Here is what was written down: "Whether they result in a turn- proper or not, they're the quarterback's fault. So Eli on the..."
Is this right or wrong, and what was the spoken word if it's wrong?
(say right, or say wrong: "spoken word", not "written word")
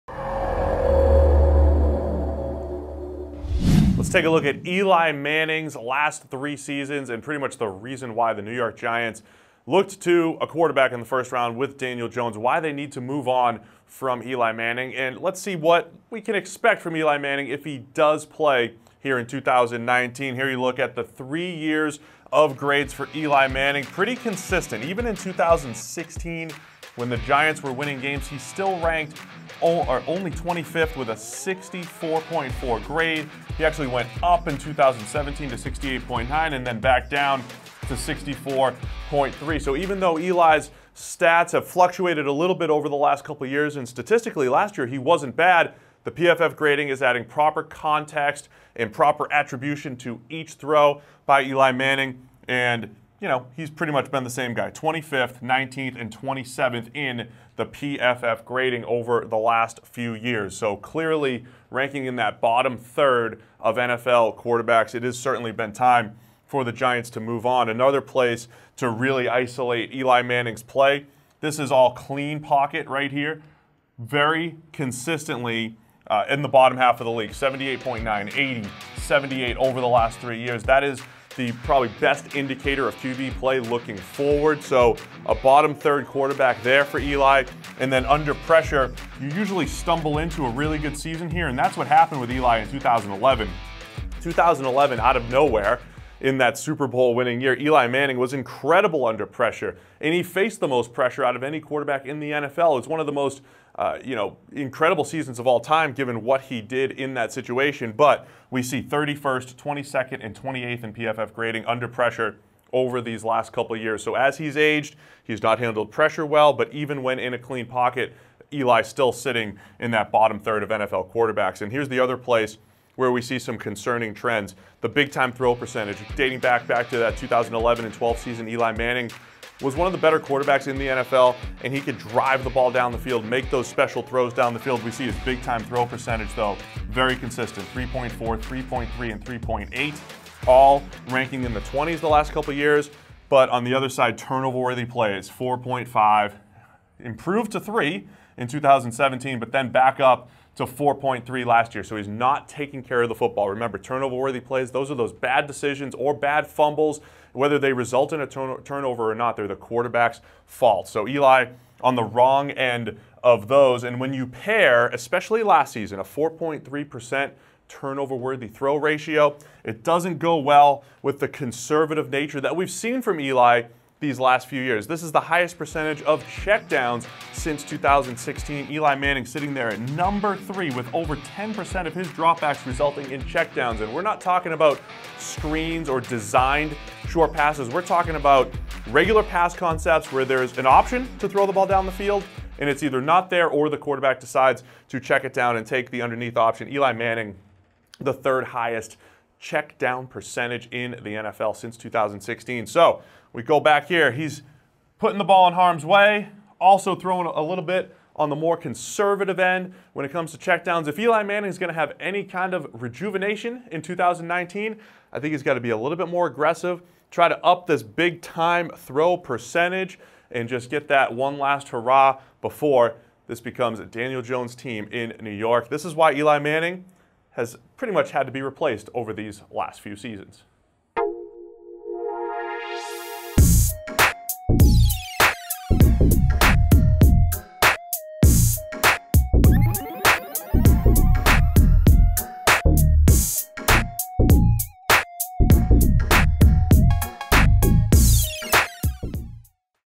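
wrong: "turnover", not "proper".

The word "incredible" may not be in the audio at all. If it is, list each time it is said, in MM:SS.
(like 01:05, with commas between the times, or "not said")
01:38, 01:44.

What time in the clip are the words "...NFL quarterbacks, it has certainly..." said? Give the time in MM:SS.
01:03.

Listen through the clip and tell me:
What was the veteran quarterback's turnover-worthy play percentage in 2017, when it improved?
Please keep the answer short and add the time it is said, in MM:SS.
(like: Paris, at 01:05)
3, at 02:26.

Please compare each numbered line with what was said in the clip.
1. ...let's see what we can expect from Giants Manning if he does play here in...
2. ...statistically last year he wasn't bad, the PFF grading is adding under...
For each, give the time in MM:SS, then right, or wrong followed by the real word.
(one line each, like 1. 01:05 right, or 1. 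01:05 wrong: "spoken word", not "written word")
1. 00:15 wrong: "Eli", not "Giants"
2. 00:43 wrong: "proper", not "under".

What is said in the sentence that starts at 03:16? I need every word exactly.
Eli Manning, the third highest check down percentage in the NFL since 2016.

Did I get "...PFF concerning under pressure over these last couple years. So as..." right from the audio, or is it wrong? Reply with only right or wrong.
wrong.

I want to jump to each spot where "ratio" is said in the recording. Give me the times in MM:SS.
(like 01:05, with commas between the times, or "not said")
02:48.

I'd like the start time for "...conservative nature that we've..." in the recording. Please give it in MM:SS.
02:51.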